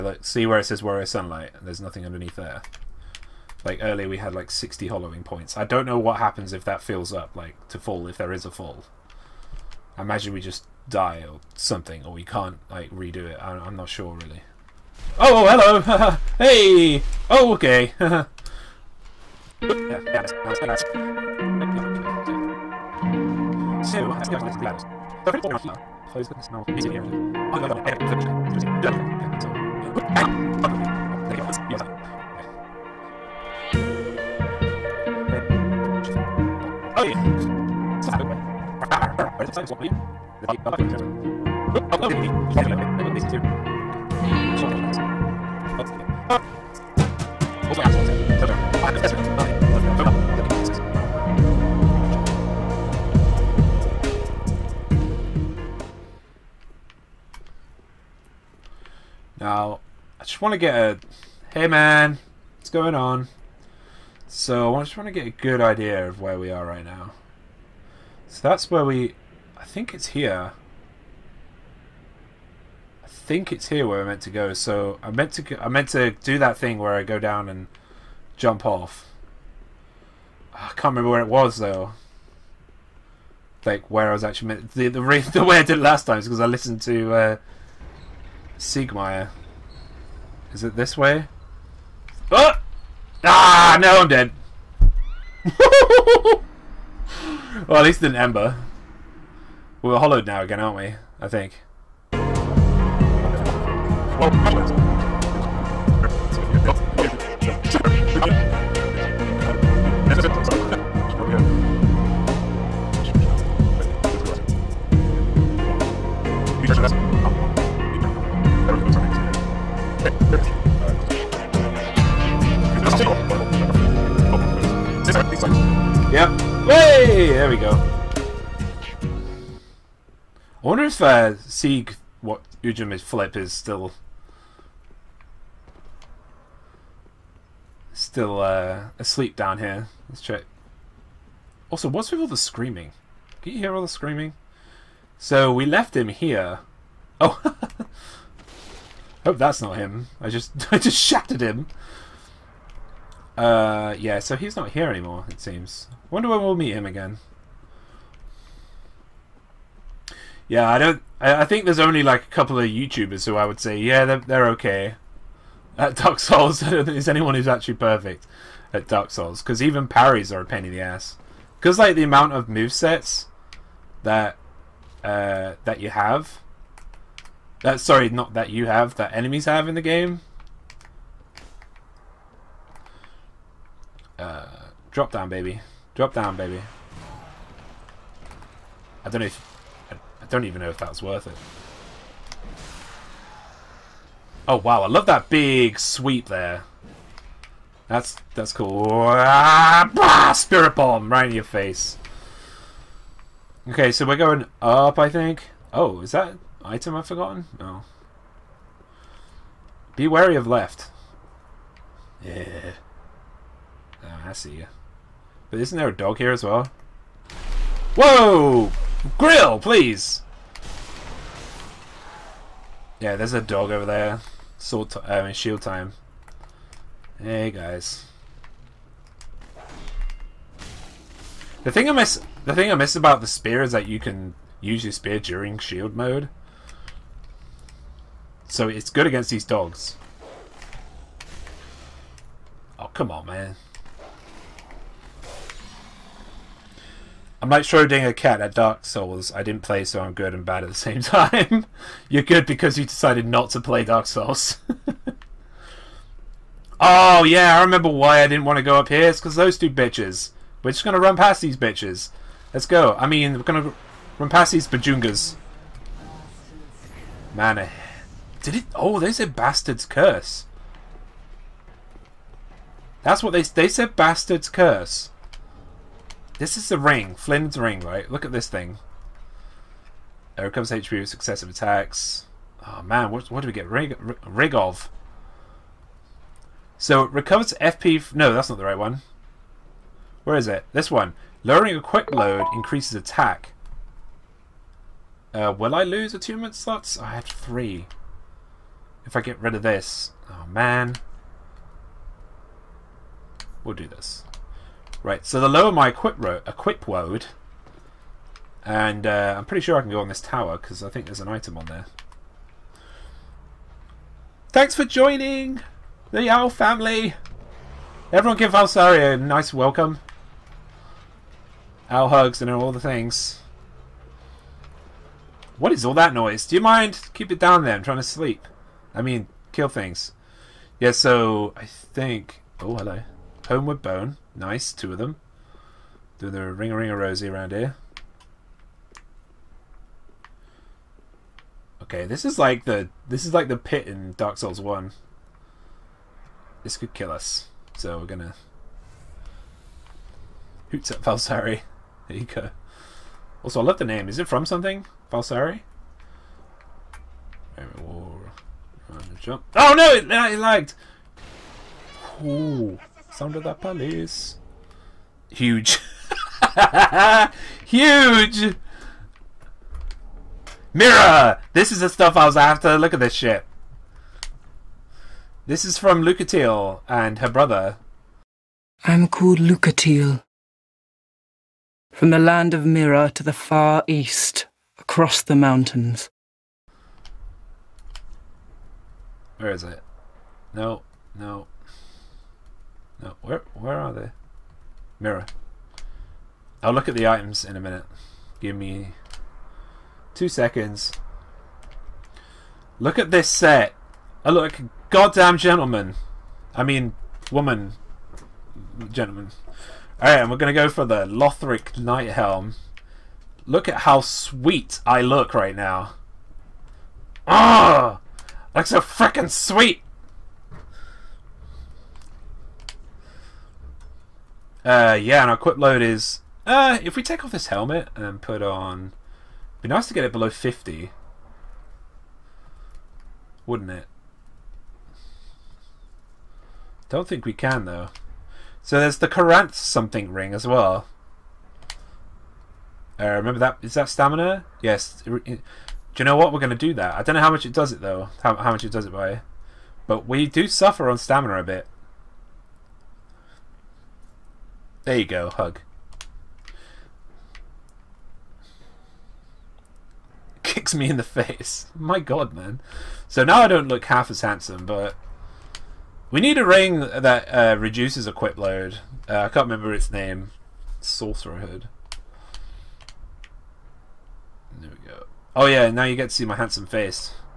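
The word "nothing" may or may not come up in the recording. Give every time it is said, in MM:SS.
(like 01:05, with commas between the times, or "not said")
00:01.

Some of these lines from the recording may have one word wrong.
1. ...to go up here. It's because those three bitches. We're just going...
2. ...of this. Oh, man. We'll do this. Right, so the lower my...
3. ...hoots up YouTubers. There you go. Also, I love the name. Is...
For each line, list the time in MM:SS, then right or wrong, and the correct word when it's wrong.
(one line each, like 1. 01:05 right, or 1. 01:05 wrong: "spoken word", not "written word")
1. 04:18 wrong: "two", not "three"
2. 04:59 right
3. 05:50 wrong: "Falsari", not "YouTubers".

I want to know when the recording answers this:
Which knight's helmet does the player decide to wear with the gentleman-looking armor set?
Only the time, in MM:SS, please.
06:51.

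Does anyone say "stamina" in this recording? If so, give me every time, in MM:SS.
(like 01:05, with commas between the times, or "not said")
07:23, 07:30.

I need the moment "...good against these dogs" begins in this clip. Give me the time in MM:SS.
03:58.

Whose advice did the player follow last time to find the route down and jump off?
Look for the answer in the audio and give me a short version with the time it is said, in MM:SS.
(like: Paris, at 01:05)
Siegmeyer, at 01:28.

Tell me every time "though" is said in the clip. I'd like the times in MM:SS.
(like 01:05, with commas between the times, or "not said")
01:21, 07:17, 07:27.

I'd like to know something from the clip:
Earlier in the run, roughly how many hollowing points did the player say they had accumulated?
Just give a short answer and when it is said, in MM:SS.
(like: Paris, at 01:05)
60, at 00:04.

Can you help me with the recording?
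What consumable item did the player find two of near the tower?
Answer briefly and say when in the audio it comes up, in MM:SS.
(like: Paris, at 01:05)
Homeward Bone, at 05:33.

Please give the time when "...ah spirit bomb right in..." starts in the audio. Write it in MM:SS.
03:19.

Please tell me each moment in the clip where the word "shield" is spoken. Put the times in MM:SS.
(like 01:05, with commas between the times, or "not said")
03:45, 03:55.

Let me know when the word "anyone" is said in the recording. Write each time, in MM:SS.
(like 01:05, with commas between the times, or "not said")
02:47.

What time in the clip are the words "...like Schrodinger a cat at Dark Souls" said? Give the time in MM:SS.
04:07.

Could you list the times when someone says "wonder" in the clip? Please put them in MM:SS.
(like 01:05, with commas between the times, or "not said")
02:10, 02:36.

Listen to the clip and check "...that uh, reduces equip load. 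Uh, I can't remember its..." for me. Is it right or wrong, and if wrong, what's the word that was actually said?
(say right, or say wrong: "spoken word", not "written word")
right.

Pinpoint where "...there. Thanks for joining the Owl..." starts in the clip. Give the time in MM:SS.
05:11.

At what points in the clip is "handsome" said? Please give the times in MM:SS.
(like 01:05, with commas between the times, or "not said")
07:44, 07:56.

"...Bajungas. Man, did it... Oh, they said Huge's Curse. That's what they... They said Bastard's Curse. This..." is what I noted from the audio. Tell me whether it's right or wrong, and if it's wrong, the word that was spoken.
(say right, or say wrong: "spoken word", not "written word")
wrong: "Bastard", not "Huge".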